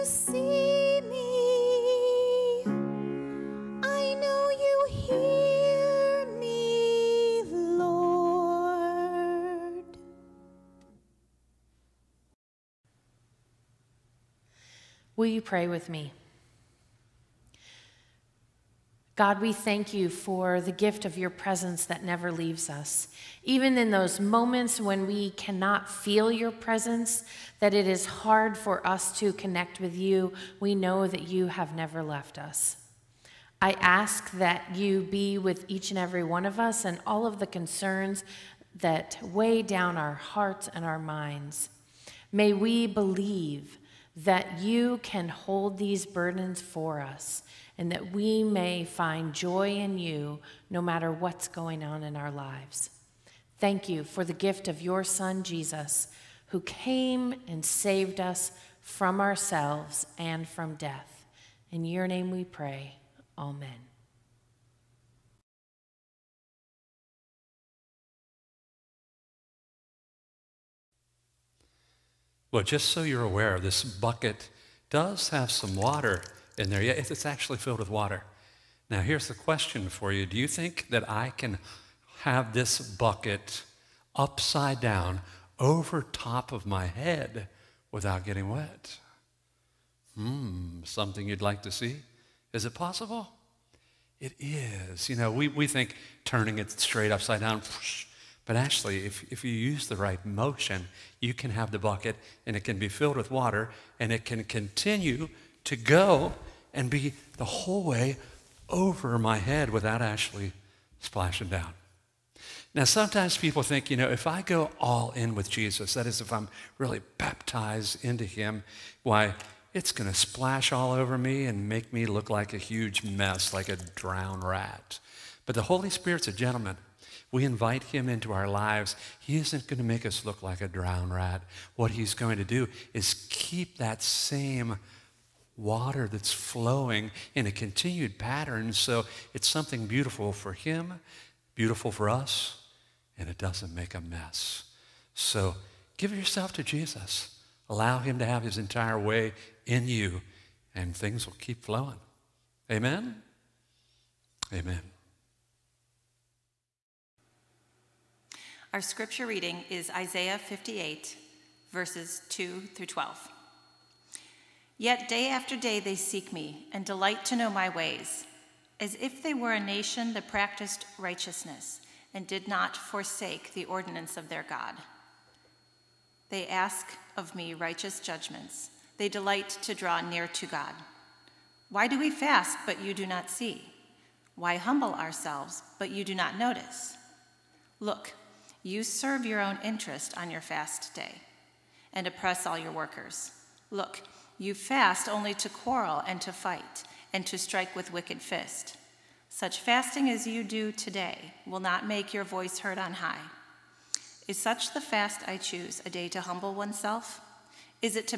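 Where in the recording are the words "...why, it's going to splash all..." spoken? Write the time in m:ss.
1:59.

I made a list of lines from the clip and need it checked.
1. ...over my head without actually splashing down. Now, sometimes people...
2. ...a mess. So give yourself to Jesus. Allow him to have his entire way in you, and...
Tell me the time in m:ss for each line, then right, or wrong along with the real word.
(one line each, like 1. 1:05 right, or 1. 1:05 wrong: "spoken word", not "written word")
1. 1:48 right
2. 2:23 right.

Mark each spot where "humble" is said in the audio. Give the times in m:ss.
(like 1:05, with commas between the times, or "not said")
3:04, 3:26.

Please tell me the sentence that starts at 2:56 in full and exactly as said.
They ask of me righteous judgments.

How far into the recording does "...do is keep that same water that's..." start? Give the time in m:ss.
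2:12.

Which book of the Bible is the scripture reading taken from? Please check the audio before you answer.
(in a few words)
Isaiah.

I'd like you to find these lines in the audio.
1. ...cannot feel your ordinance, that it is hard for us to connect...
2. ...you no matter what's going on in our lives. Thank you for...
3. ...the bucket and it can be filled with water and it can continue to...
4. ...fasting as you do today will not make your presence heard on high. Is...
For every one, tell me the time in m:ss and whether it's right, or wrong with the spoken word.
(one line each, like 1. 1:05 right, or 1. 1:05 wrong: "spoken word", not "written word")
1. 0:25 wrong: "presence", not "ordinance"
2. 0:49 right
3. 1:41 right
4. 3:19 wrong: "voice", not "presence".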